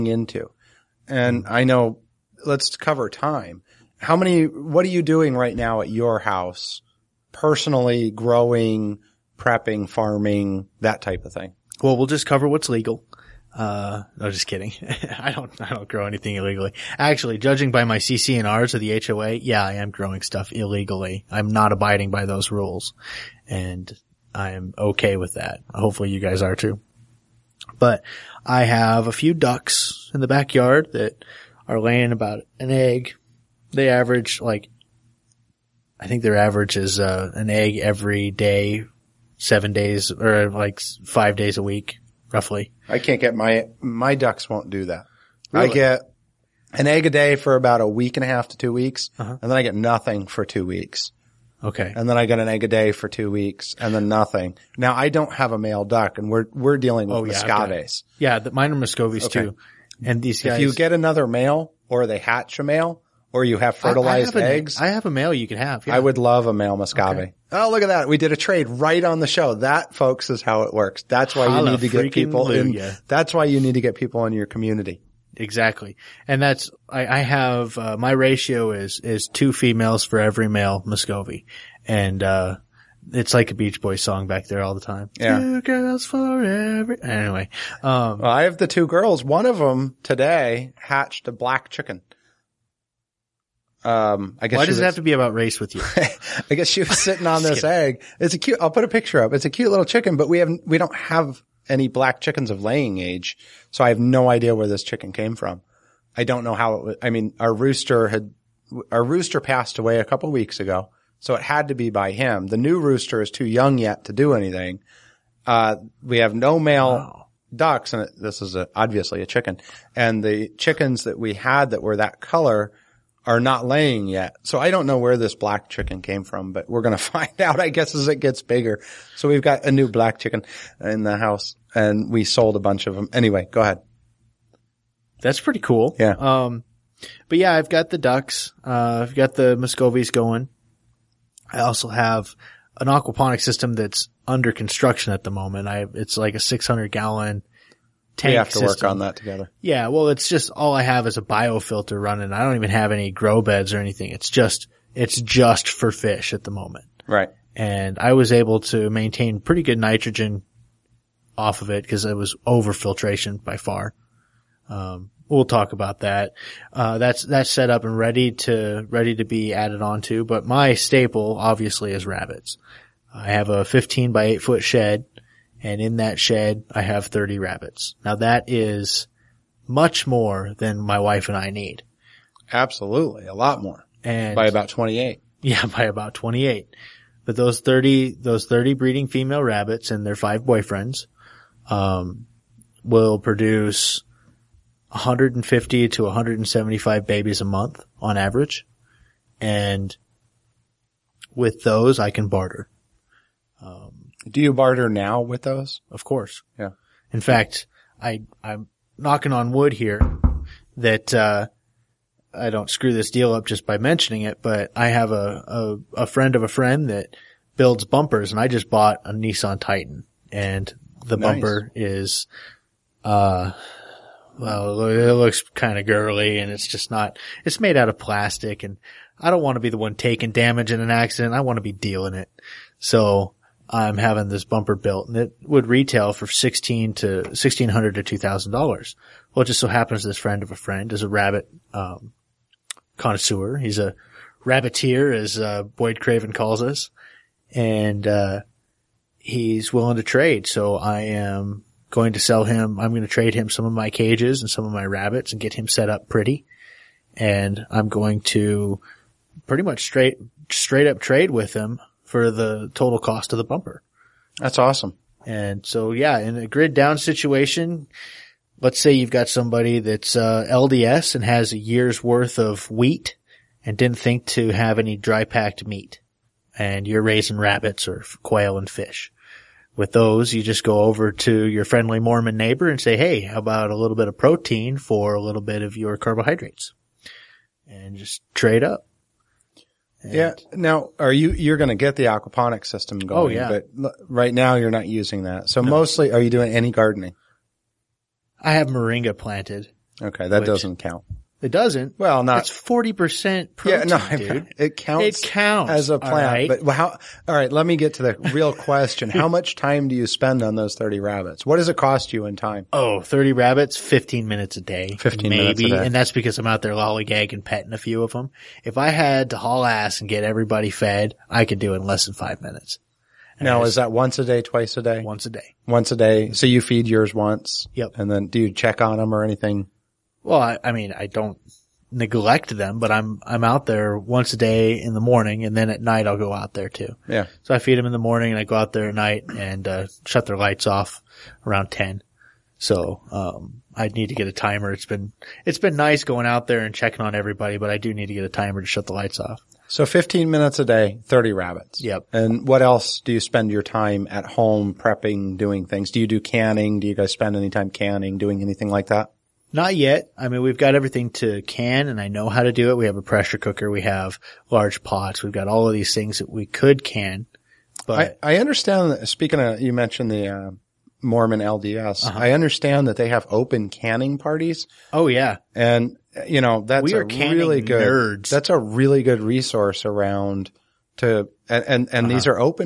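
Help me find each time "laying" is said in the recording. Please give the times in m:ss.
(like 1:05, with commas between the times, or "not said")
0:31, 1:42, 2:03.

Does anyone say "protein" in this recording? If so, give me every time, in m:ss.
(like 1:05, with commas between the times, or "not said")
4:44, 5:03.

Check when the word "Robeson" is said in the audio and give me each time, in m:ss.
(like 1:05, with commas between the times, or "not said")
not said.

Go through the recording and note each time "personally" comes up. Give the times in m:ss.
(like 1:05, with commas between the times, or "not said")
0:07.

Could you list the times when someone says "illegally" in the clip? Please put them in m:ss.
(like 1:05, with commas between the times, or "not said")
0:16, 0:20.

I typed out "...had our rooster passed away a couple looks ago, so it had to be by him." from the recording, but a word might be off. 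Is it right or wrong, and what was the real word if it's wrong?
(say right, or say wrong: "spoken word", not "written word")
wrong: "weeks", not "looks".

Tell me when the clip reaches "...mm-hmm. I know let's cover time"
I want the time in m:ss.
0:01.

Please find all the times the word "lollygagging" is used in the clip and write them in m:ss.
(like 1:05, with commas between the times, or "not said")
5:16.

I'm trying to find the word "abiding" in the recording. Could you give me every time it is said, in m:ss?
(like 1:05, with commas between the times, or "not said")
0:21.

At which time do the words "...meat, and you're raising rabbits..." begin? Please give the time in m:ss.
4:35.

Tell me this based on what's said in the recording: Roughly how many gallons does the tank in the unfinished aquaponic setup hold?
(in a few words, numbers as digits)
600.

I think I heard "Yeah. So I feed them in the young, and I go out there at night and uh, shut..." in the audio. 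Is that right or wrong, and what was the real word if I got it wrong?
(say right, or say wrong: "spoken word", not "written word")
wrong: "morning", not "young".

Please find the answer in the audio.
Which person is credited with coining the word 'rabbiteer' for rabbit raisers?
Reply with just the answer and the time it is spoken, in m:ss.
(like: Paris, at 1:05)
Boyd Craven, at 4:05.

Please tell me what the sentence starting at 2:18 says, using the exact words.
Uh, I've got the Muscovies going.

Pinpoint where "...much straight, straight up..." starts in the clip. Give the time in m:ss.
4:19.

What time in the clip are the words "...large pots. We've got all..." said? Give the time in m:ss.
6:04.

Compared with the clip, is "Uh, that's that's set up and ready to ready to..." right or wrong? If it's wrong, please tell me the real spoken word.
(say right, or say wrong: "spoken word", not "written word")
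right.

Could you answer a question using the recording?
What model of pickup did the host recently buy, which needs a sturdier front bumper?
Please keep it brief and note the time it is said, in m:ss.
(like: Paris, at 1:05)
Nissan Titan, at 3:39.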